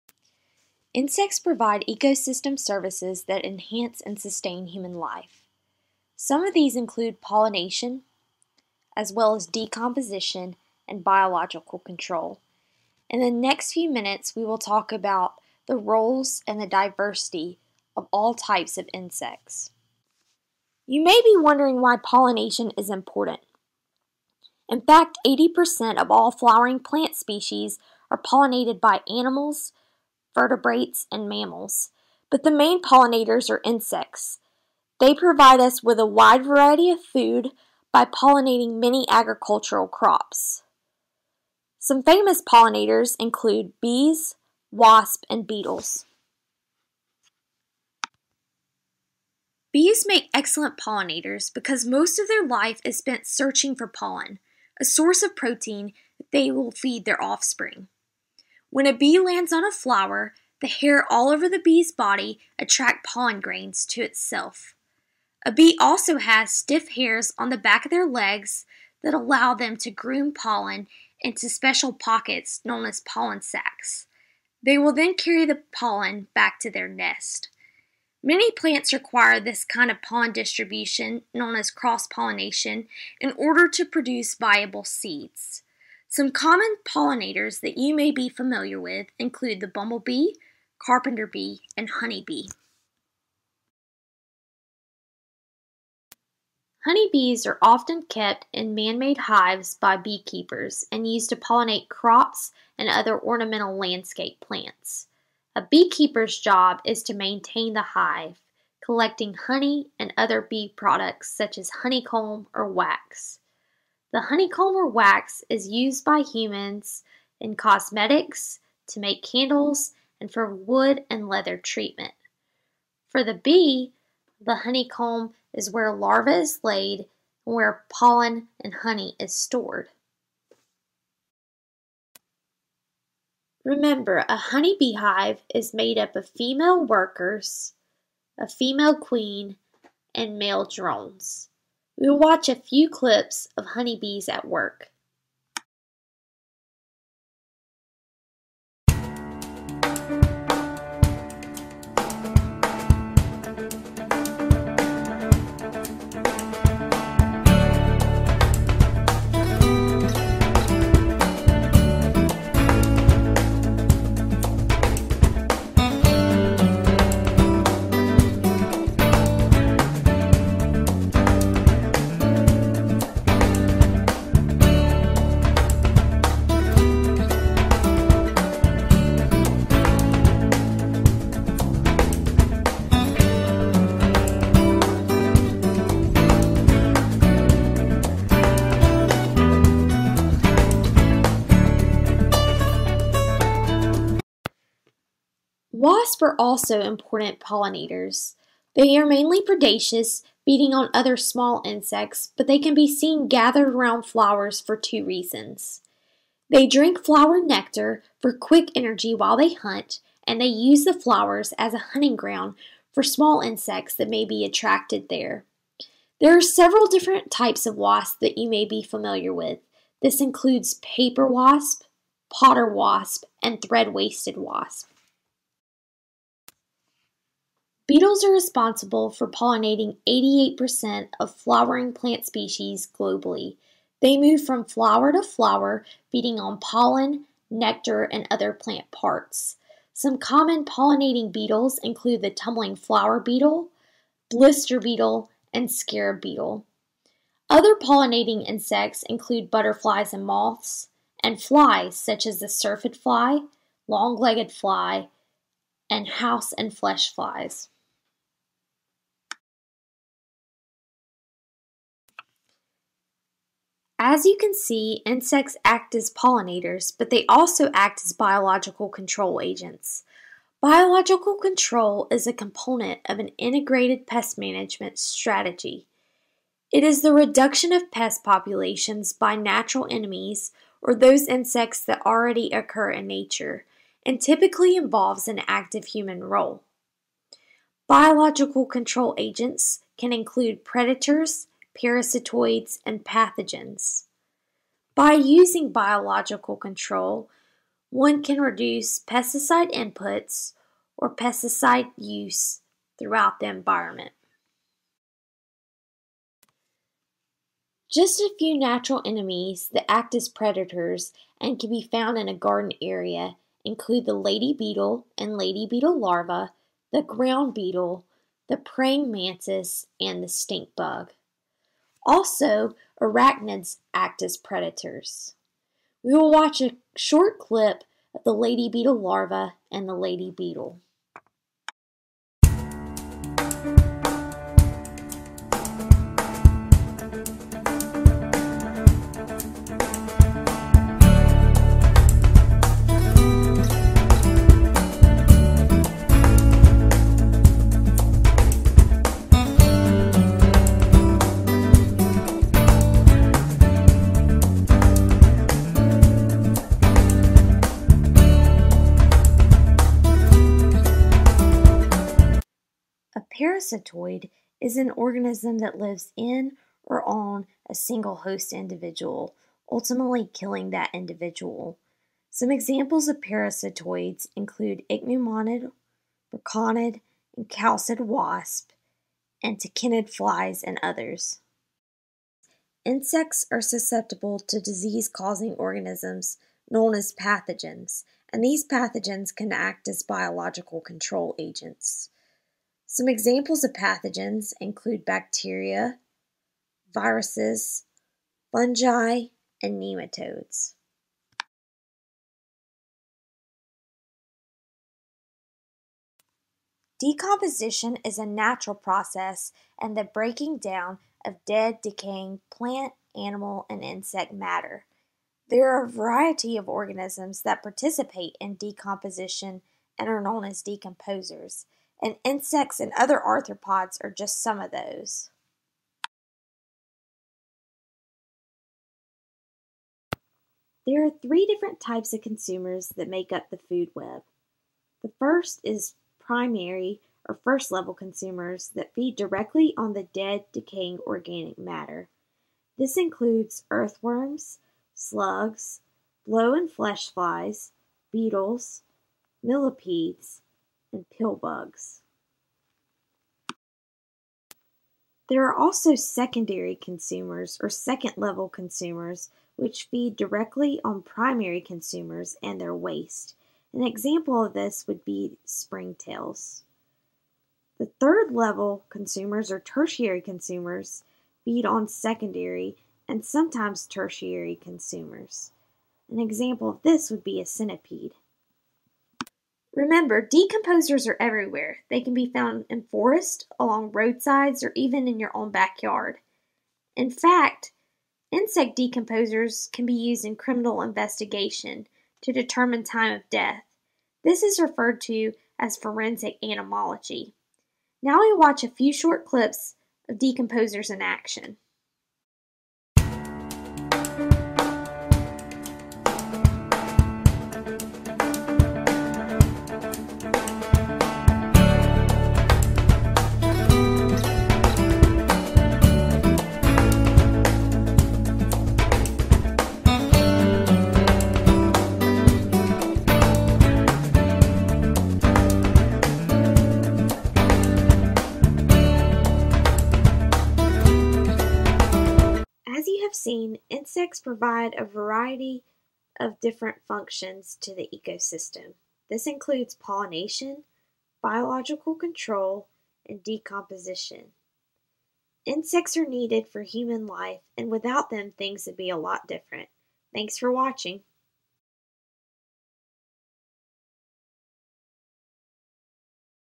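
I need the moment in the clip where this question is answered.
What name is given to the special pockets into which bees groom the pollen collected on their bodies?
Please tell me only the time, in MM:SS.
01:13.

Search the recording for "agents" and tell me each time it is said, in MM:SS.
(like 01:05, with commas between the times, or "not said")
04:29, 04:49, 06:31.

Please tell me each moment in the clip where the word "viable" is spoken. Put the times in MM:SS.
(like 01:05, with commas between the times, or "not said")
01:24.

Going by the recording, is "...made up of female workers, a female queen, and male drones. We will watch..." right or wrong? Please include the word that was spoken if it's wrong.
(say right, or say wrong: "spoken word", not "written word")
right.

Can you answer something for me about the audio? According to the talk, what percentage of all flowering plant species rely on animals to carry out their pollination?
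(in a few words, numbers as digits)
80%.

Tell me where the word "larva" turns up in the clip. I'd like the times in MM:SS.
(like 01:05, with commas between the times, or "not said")
02:05, 05:15, 05:28.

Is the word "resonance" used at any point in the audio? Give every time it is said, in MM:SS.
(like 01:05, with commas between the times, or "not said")
not said.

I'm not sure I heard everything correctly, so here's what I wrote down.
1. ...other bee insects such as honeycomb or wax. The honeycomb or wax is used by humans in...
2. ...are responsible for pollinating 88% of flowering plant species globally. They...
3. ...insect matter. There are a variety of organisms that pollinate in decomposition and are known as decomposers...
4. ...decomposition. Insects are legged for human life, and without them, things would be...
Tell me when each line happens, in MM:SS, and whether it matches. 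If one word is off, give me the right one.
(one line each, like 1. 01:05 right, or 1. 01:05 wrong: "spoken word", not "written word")
1. 01:50 wrong: "products", not "insects"
2. 03:48 right
3. 06:53 wrong: "participate", not "pollinate"
4. 09:03 wrong: "needed", not "legged".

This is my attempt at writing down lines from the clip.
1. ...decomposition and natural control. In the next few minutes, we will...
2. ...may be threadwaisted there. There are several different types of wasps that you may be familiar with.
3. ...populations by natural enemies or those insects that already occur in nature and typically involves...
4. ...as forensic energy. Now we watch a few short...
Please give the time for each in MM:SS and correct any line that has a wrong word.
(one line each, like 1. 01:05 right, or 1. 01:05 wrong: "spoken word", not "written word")
1. 00:09 wrong: "biological", not "natural"
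2. 03:34 wrong: "attracted", not "threadwaisted"
3. 04:38 right
4. 08:15 wrong: "entomology", not "energy".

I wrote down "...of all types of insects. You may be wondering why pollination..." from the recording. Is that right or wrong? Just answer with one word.
right.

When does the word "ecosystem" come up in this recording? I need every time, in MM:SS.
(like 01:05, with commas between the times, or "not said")
00:01, 08:57.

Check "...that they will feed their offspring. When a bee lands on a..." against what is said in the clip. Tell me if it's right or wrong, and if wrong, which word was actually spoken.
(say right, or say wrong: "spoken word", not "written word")
right.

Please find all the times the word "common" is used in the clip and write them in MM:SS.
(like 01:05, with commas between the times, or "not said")
01:26, 04:00.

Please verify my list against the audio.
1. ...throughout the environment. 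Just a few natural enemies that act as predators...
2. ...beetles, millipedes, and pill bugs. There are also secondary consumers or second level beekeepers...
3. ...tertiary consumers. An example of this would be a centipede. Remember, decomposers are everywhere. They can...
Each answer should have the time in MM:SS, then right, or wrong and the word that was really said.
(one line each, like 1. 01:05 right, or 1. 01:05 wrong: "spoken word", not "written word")
1. 05:02 right
2. 07:28 wrong: "consumers", not "beekeepers"
3. 07:53 right.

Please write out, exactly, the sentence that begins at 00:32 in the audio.
But the main pollinators are insects.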